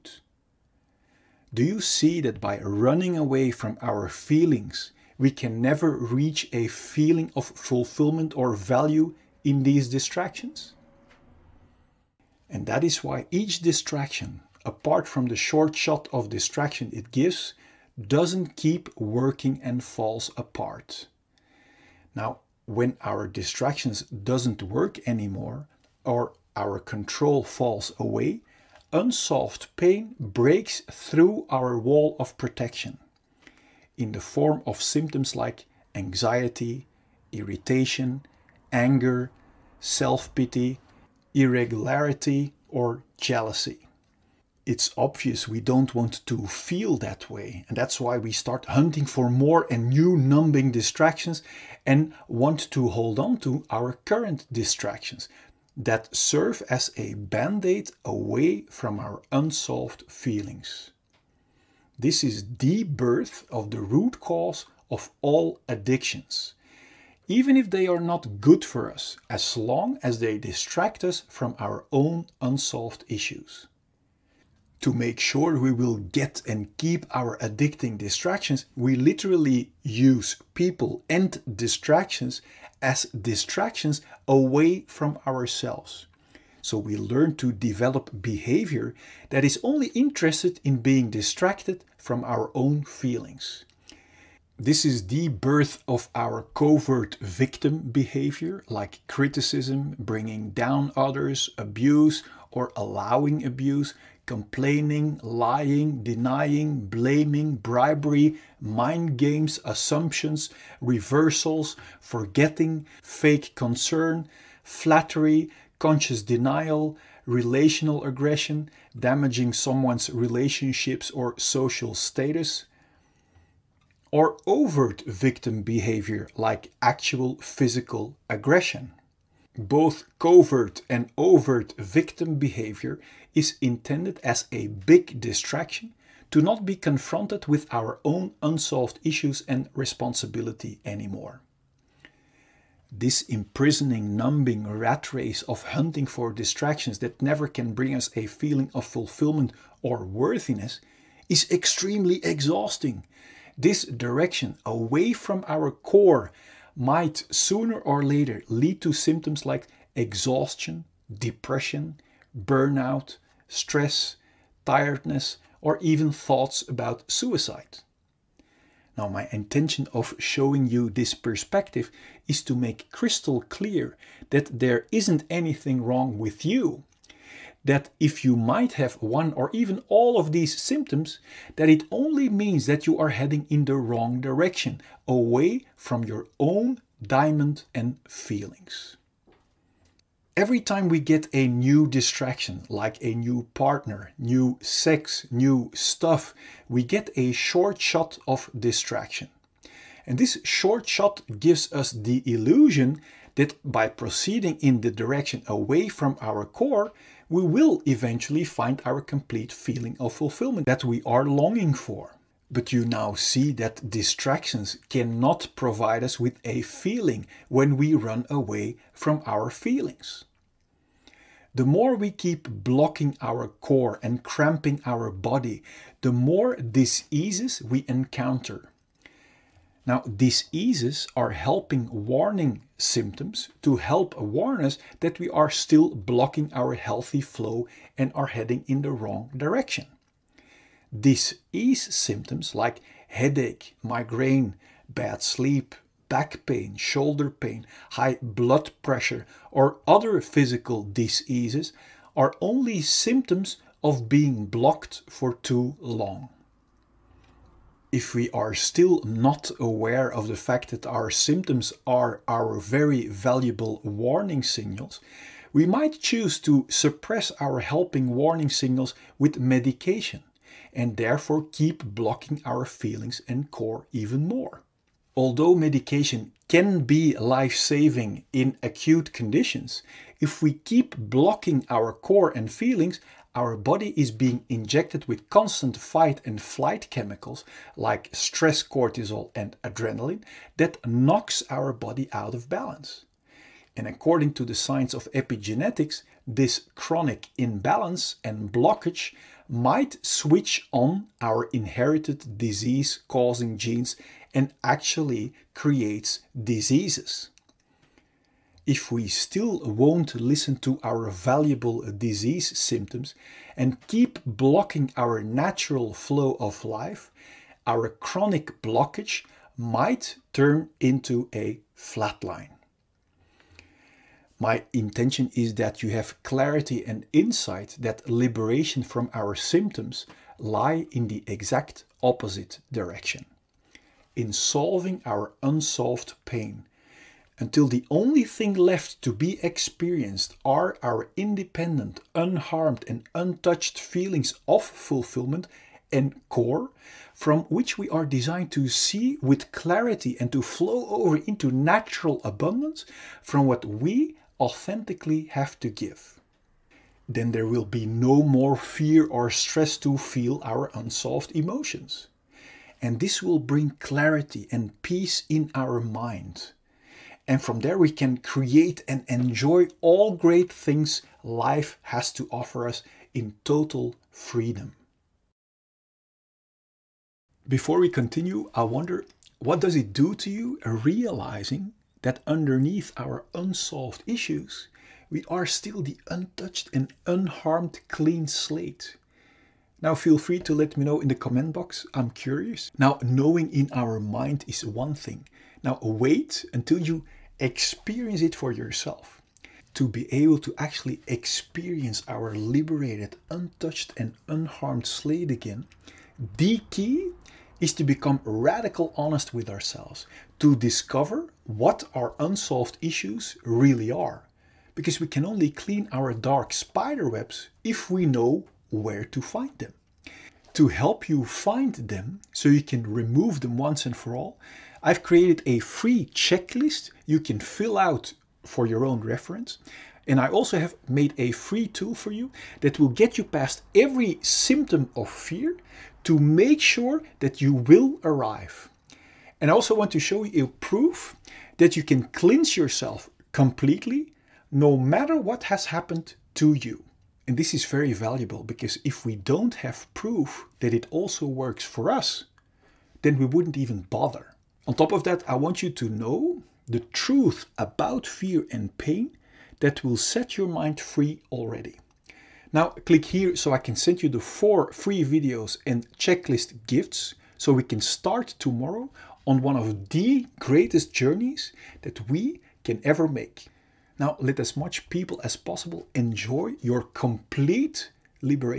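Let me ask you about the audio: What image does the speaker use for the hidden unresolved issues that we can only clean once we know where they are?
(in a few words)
dark spider webs.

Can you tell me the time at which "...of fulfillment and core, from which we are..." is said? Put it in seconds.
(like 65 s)
344 s.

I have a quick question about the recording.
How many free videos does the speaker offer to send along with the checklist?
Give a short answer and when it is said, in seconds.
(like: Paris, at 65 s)
4, at 464 s.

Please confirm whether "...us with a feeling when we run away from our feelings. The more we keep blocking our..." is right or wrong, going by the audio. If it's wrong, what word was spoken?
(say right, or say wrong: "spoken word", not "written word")
right.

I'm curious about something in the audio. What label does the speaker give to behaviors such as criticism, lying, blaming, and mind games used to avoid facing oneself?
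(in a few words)
covert victim behavior.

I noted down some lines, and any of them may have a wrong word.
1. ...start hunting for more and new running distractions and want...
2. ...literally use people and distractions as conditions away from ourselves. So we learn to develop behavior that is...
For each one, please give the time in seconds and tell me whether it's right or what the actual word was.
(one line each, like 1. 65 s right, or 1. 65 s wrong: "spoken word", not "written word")
1. 48 s wrong: "numbing", not "running"
2. 78 s wrong: "distractions", not "conditions".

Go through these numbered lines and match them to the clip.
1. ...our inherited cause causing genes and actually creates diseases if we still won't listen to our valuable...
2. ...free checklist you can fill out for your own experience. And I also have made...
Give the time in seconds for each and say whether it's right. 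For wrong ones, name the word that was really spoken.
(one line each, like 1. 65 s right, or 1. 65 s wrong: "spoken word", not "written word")
1. 301 s wrong: "disease", not "cause"
2. 425 s wrong: "reference", not "experience".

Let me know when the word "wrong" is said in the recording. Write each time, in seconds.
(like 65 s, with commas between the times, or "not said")
175 s, 183 s, 238 s.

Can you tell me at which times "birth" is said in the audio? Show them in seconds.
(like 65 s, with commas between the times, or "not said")
62 s, 95 s.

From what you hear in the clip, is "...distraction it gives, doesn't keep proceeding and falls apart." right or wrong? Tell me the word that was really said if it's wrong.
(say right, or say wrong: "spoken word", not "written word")
wrong: "working", not "proceeding".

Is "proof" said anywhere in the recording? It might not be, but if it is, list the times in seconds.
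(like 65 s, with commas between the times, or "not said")
440 s, 449 s.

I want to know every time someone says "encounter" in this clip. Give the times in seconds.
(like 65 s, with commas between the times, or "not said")
227 s.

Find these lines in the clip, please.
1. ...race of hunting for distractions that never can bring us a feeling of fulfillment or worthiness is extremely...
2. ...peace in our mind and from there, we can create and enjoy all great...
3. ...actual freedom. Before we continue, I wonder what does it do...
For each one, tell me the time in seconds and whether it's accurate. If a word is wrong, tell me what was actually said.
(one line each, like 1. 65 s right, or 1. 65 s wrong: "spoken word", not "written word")
1. 145 s right
2. 364 s right
3. 373 s wrong: "total", not "actual".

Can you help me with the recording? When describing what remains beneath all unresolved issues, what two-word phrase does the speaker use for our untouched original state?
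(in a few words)
clean slate.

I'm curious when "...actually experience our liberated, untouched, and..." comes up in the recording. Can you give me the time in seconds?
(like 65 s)
400 s.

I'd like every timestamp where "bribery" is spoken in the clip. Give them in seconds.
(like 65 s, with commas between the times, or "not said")
107 s.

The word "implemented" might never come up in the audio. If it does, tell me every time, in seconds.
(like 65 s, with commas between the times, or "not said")
not said.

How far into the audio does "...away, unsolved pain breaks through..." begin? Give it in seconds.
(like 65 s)
27 s.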